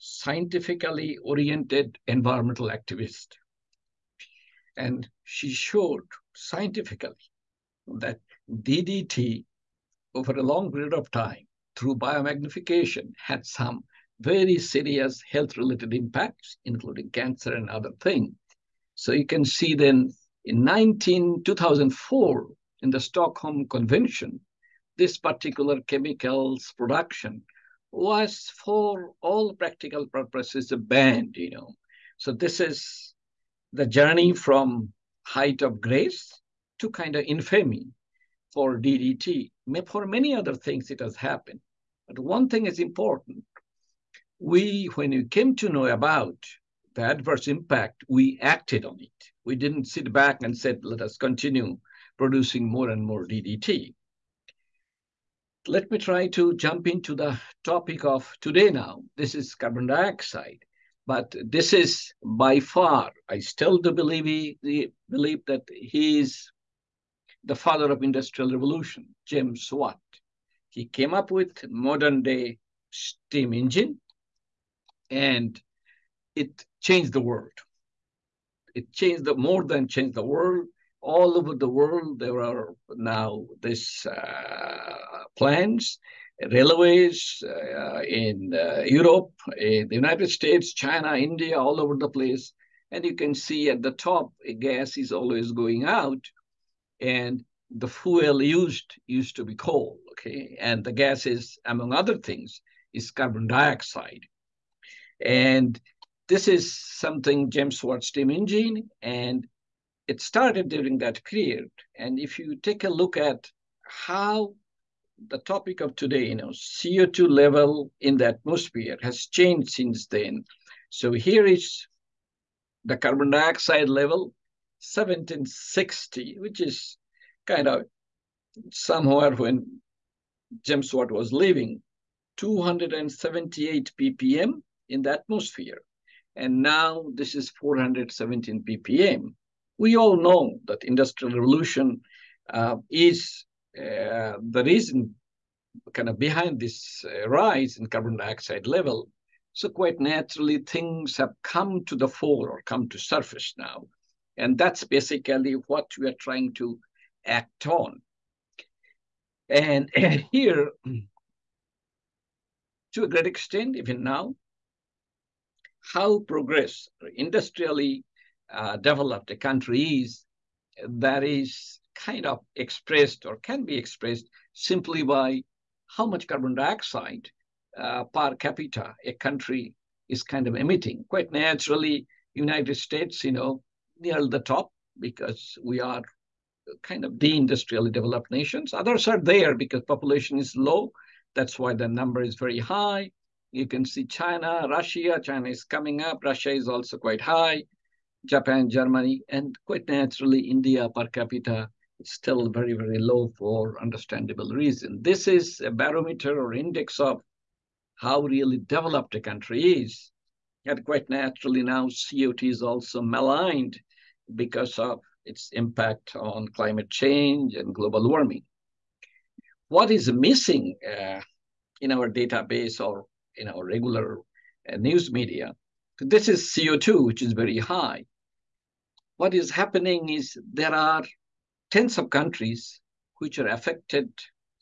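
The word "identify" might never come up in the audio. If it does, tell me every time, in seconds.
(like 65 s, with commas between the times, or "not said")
not said.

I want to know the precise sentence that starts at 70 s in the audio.
He came up with modern day steam engine and it changed the world.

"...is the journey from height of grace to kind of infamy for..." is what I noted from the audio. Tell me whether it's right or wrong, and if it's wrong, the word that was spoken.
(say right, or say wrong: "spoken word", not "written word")
right.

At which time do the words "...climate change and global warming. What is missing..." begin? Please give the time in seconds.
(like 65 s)
216 s.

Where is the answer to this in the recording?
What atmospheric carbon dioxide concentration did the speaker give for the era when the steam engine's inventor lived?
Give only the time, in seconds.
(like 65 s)
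132 s.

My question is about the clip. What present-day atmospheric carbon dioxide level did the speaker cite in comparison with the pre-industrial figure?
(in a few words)
417 ppm.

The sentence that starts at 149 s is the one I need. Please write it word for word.
So quite naturally, things have come to the fore or come to surface now.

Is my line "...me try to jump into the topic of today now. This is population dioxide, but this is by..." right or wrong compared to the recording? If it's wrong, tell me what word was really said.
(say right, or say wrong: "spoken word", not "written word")
wrong: "carbon", not "population".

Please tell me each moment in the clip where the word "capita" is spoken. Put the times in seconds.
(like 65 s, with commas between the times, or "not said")
178 s, 201 s.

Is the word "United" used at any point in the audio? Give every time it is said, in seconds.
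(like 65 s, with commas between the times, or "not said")
89 s, 182 s.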